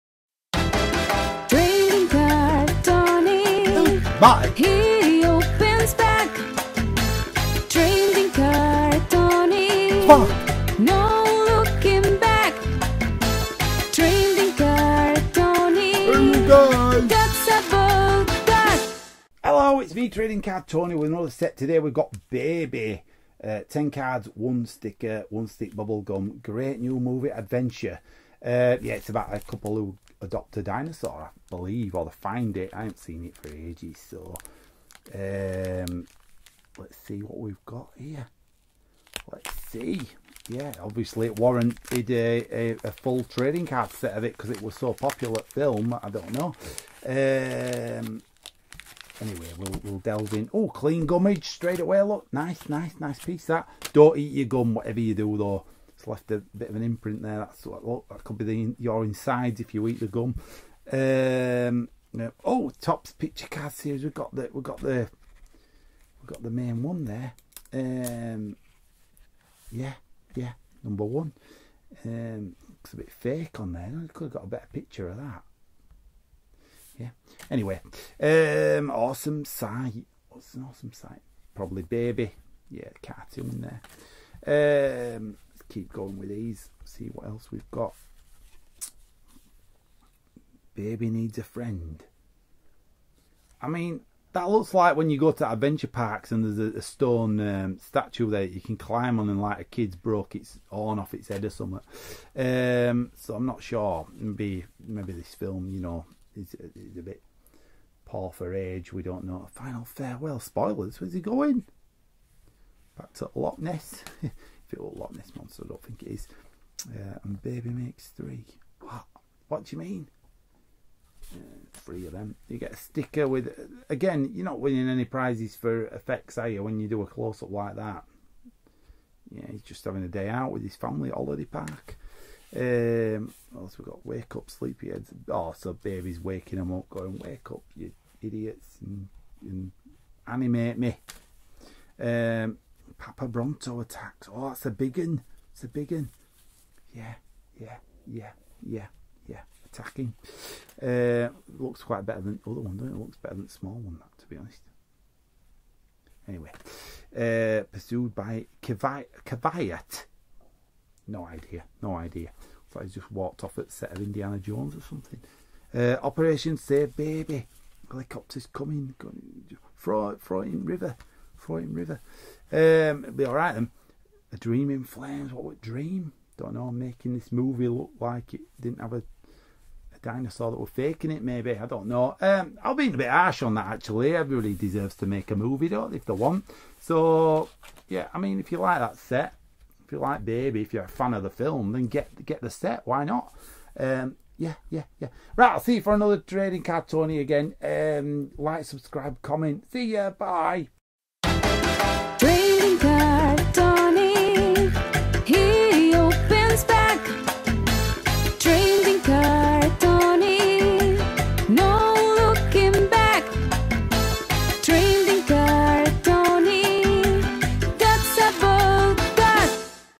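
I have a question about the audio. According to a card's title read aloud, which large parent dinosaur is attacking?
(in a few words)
Papa Bronto.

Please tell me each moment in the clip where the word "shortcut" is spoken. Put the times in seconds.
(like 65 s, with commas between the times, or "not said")
not said.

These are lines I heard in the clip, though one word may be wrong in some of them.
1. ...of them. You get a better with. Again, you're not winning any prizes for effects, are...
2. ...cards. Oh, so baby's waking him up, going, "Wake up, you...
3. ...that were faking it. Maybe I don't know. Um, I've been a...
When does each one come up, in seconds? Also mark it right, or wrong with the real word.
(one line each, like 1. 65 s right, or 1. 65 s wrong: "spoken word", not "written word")
1. 122 s wrong: "sticker", not "better"
2. 134 s wrong: "sleepyheads", not "cards"
3. 180 s right.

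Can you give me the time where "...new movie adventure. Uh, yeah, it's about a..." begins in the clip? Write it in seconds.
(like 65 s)
26 s.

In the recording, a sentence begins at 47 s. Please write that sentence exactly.
Um, anyway, we'll, we'll delve in.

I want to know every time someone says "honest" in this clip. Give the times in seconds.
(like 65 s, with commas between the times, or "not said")
154 s.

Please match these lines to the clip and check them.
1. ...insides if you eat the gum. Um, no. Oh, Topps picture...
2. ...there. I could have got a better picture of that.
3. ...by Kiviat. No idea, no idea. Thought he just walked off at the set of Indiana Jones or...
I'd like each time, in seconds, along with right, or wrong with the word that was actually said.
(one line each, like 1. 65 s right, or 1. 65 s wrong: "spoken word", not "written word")
1. 59 s right
2. 73 s right
3. 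158 s right.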